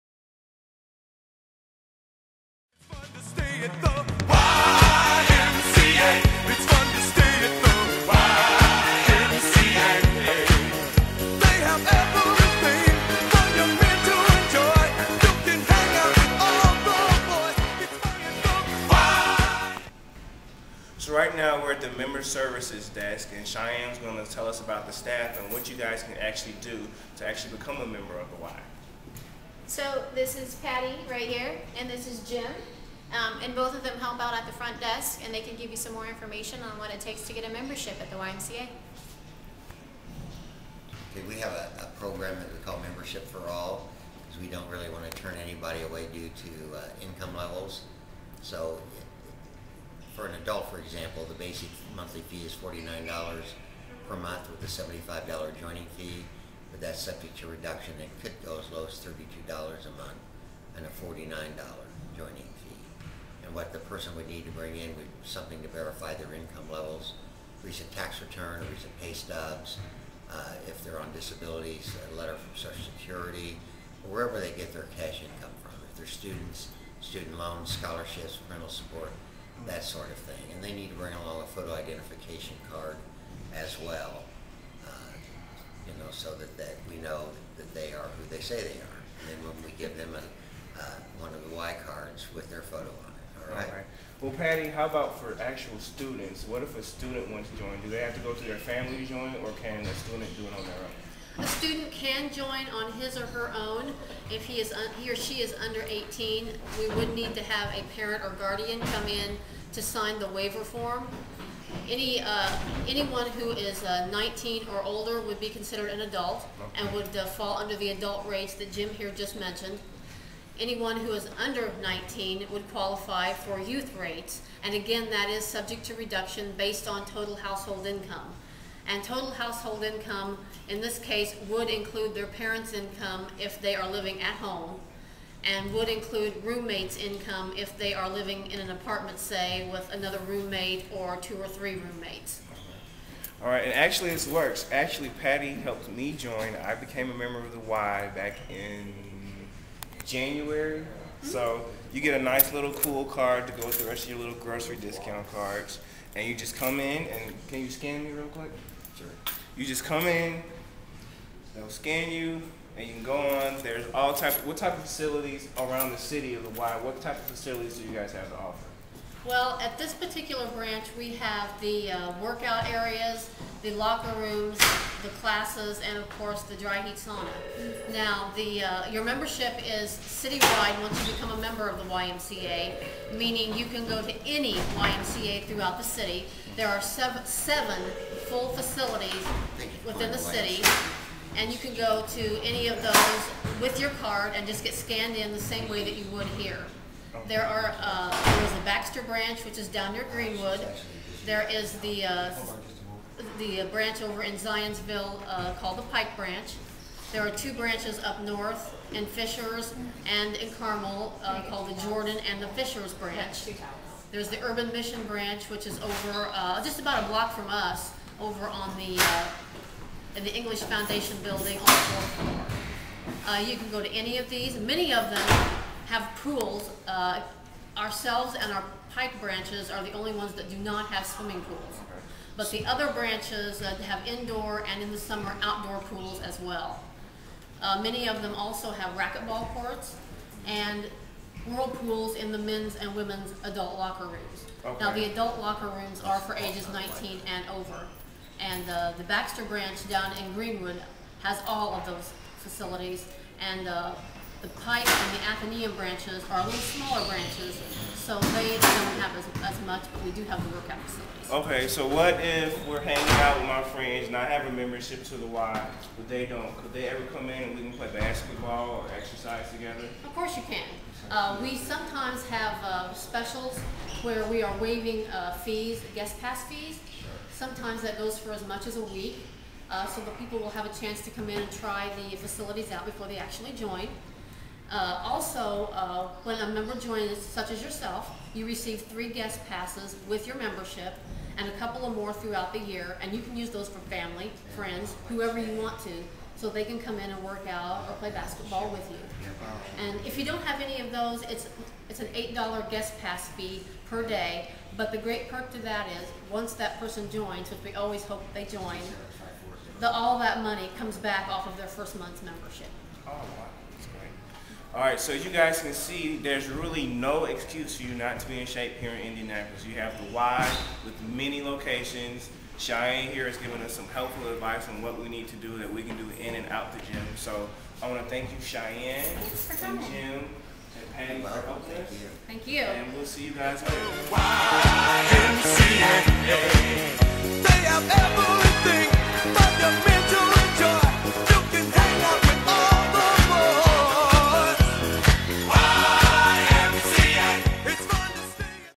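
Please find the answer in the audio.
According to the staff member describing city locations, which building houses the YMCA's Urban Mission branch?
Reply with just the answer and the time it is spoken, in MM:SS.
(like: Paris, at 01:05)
English Foundation building, at 03:40.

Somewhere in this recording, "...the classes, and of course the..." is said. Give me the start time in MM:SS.
02:55.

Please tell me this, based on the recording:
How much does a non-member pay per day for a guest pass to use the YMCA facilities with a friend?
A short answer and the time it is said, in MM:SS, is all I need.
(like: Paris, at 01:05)
$8, at 05:02.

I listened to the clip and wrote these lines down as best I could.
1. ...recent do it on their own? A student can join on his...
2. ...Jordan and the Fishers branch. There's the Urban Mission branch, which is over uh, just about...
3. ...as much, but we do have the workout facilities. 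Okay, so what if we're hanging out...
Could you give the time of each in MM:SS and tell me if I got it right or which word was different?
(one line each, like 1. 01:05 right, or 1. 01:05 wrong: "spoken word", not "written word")
1. 01:39 wrong: "student", not "recent"
2. 03:31 right
3. 04:19 right.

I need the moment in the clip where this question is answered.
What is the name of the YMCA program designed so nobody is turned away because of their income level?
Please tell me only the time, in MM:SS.
00:42.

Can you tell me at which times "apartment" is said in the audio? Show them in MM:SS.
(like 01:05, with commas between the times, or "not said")
02:18.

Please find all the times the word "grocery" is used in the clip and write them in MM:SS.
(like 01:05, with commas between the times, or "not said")
02:34.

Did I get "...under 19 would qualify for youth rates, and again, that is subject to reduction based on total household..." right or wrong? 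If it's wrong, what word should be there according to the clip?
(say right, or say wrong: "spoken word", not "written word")
right.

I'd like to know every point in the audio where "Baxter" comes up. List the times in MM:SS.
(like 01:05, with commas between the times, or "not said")
03:18, 04:09.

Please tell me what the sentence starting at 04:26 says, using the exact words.
Could they ever come in and we can play basketball or exercise together?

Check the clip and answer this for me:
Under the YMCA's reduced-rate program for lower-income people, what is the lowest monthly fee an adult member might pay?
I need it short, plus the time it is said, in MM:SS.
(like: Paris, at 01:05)
$32, at 00:58.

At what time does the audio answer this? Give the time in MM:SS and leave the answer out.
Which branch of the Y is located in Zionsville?
03:25.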